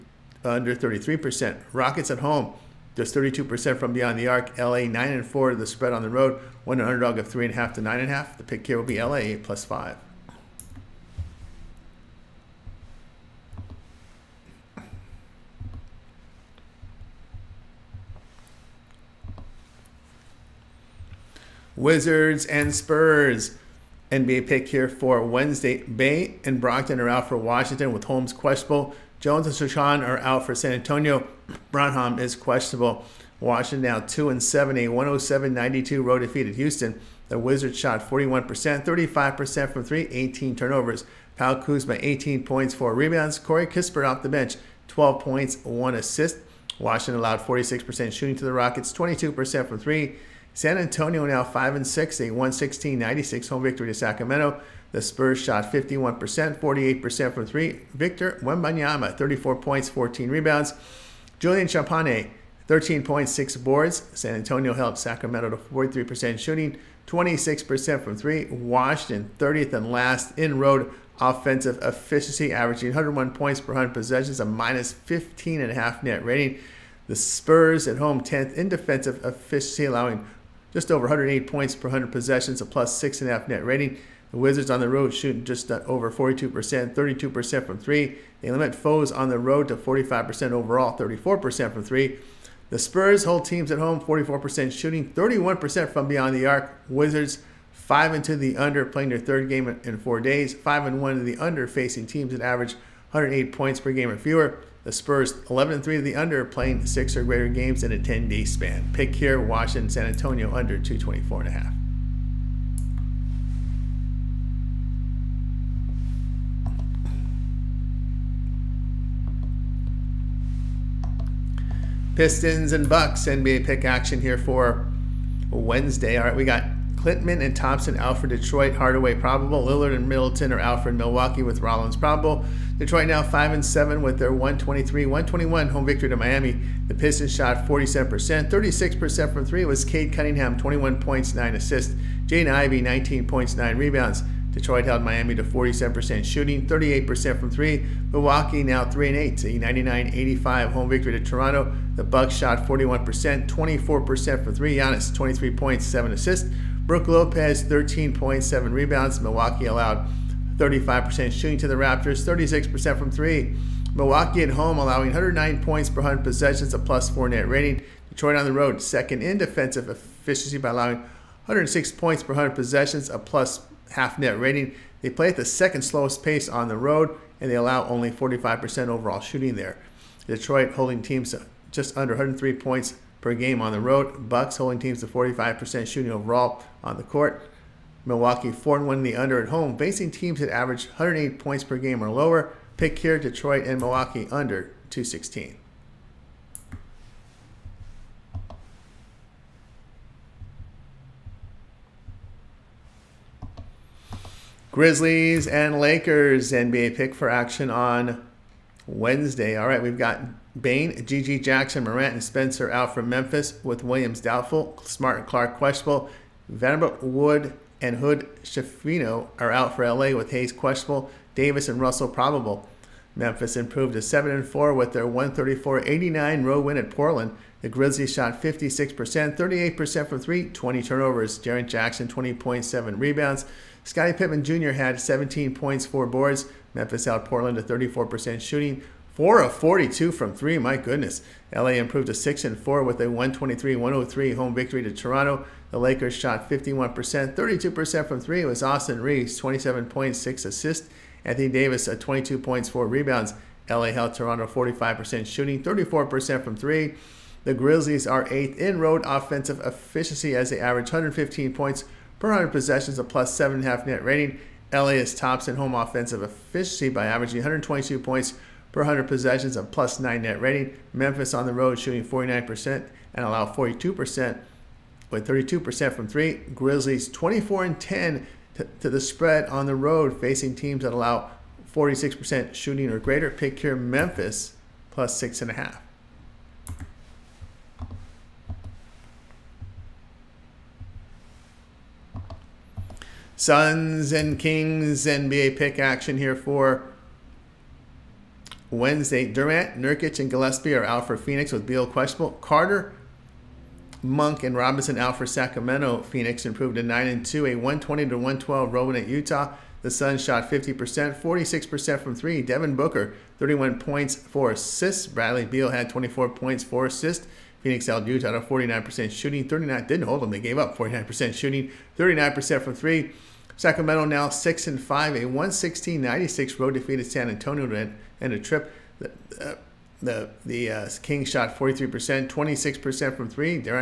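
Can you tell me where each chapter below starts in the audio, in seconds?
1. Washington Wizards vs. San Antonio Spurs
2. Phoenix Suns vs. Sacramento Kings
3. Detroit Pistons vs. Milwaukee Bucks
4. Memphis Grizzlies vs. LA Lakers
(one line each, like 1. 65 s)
1. 20 s
2. 292 s
3. 121 s
4. 203 s.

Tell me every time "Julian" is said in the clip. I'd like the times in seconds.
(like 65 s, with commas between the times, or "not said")
61 s.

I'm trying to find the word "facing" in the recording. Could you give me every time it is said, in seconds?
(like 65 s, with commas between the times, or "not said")
101 s, 189 s, 280 s.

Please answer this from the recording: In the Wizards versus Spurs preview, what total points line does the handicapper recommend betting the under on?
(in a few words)
224.5.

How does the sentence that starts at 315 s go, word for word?
Bradley Beal had 24 points, 4 assists.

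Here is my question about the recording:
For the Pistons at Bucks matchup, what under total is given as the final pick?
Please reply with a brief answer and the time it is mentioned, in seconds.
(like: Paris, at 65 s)
216, at 194 s.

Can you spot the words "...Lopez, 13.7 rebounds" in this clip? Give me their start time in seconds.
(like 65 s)
157 s.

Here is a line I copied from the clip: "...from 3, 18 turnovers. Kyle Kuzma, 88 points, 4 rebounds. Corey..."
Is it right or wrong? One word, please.
wrong.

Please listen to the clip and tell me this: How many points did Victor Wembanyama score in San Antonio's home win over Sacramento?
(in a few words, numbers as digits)
34.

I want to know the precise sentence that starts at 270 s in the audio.
Memphis on the road shooting 49% and allow 42% with 32% from three.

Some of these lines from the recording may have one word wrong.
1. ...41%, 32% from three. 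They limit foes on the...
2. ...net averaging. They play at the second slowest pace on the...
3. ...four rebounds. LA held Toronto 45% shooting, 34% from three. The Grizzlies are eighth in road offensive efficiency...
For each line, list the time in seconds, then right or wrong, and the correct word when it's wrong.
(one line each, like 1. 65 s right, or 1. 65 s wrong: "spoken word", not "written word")
1. 86 s wrong: "42", not "41"
2. 174 s wrong: "rating", not "averaging"
3. 252 s right.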